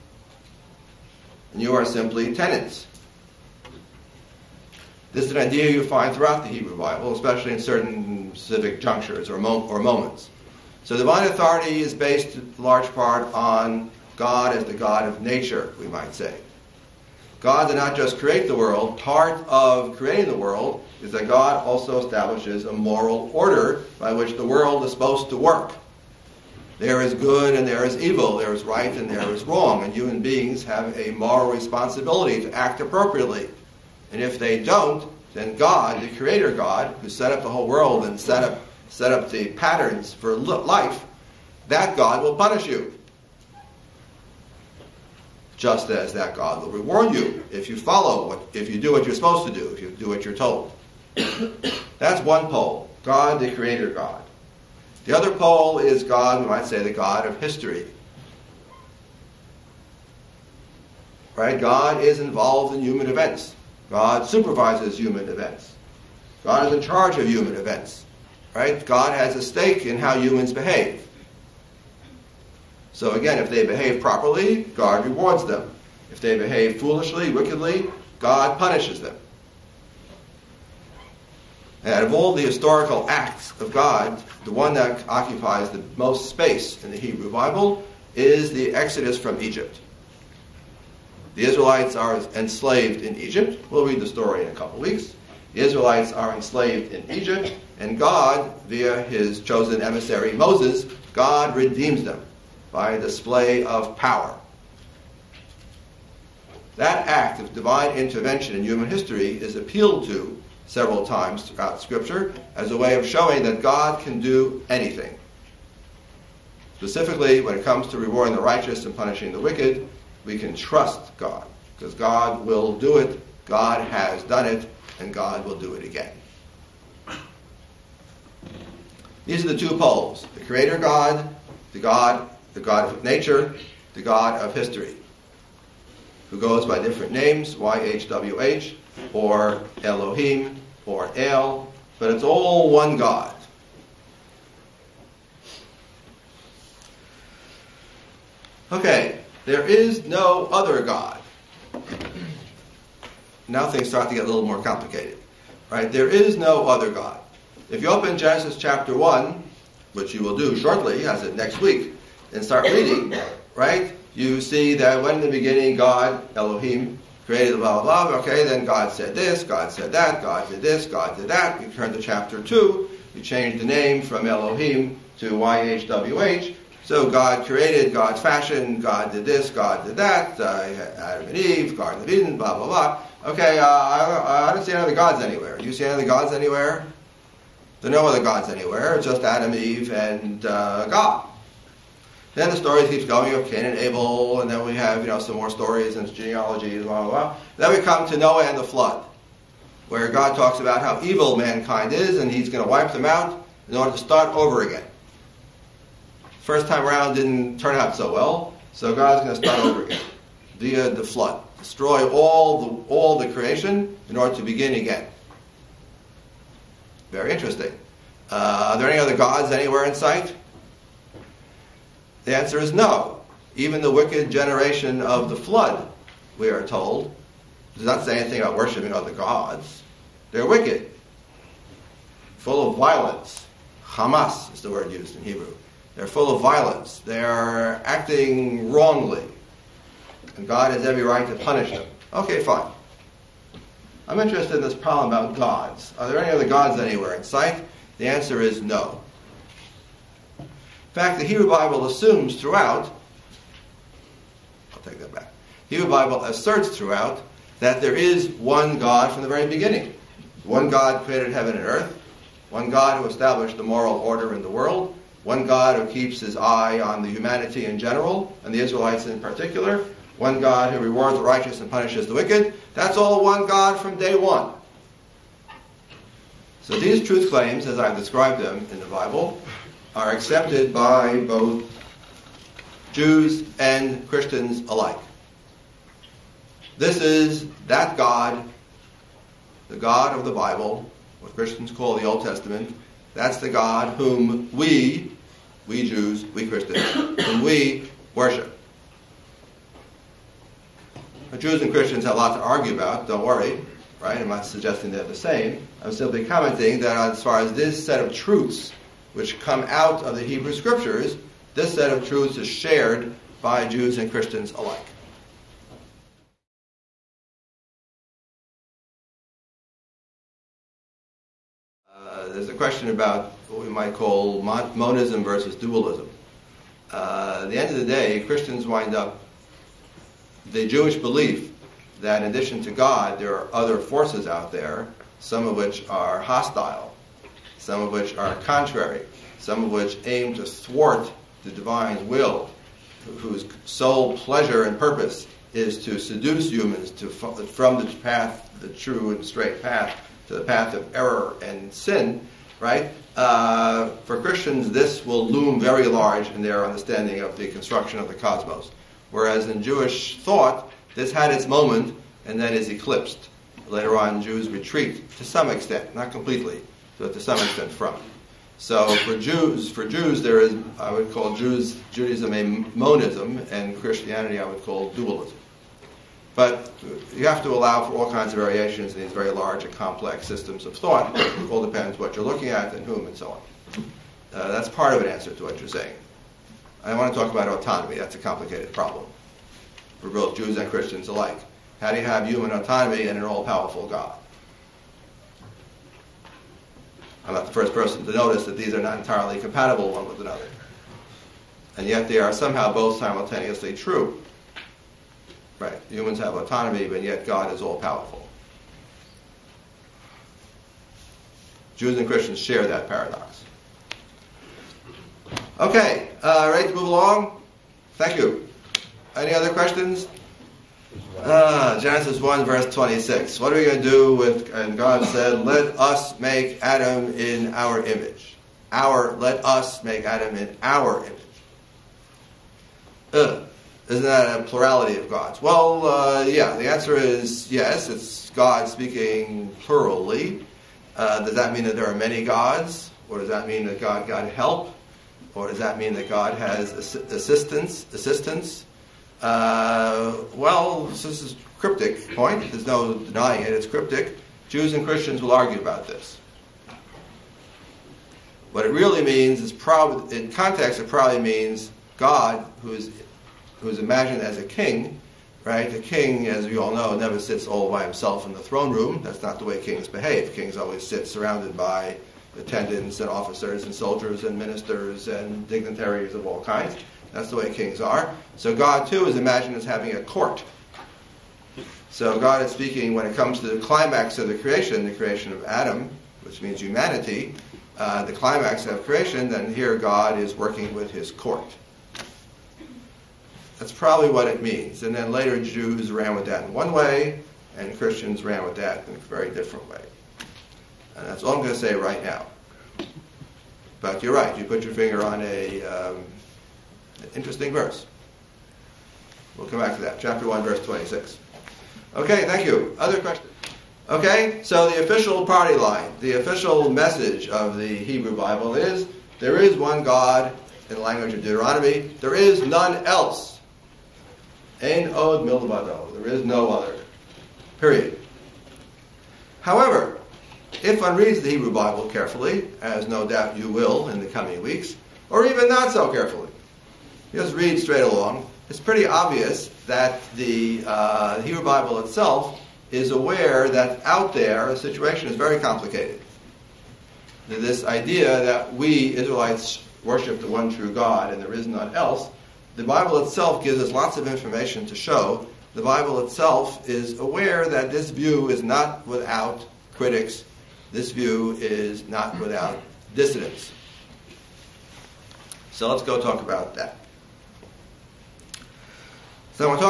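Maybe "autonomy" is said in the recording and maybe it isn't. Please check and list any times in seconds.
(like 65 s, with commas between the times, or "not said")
387 s, 392 s, 406 s.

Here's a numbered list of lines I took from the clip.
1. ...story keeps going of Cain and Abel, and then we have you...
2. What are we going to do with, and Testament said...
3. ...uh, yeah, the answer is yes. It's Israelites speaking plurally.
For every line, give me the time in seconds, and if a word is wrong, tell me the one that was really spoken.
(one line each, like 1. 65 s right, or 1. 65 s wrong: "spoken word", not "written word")
1. 192 s right
2. 423 s wrong: "God", not "Testament"
3. 435 s wrong: "God", not "Israelites".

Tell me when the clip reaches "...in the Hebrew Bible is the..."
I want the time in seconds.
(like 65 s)
86 s.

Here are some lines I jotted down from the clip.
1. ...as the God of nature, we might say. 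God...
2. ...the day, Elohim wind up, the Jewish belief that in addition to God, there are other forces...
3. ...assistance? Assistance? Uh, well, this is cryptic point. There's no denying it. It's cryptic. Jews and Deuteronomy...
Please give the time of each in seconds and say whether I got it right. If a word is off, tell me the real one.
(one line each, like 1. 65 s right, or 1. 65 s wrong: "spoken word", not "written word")
1. 14 s right
2. 327 s wrong: "Christians", not "Elohim"
3. 446 s wrong: "Christians", not "Deuteronomy".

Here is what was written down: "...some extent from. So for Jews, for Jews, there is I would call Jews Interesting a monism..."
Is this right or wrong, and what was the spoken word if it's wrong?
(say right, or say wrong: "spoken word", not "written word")
wrong: "Judaism", not "Interesting".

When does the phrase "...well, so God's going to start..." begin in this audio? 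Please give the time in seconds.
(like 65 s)
208 s.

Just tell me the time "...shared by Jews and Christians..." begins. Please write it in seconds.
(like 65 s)
312 s.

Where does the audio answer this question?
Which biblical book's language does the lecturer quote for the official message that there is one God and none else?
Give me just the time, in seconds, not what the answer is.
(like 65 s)
521 s.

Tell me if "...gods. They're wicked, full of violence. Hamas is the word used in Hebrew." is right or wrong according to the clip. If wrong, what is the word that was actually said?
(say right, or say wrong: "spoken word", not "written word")
right.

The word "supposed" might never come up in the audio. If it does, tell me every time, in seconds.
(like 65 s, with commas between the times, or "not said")
24 s, 49 s.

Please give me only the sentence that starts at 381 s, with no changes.
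It all depends what you're looking at and whom and so on.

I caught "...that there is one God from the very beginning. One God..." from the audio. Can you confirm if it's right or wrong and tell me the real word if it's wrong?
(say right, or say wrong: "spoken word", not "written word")
right.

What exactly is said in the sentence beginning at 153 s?
Now things start to get a little more complicated.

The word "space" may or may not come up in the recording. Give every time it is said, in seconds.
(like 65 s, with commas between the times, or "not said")
86 s.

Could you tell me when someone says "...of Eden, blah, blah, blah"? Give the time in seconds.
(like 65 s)
182 s.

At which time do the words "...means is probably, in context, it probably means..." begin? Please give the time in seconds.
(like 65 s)
459 s.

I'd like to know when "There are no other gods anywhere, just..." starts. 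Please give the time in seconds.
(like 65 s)
187 s.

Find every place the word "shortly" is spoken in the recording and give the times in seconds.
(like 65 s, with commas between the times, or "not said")
160 s.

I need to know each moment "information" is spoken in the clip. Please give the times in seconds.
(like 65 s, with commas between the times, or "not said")
554 s.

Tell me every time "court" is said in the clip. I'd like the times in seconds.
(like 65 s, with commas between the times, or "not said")
480 s, 491 s.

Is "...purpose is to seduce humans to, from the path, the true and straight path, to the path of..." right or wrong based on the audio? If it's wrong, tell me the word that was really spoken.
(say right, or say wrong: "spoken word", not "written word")
right.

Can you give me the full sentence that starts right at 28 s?
There is right and there is wrong.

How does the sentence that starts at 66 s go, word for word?
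God is in charge of human events.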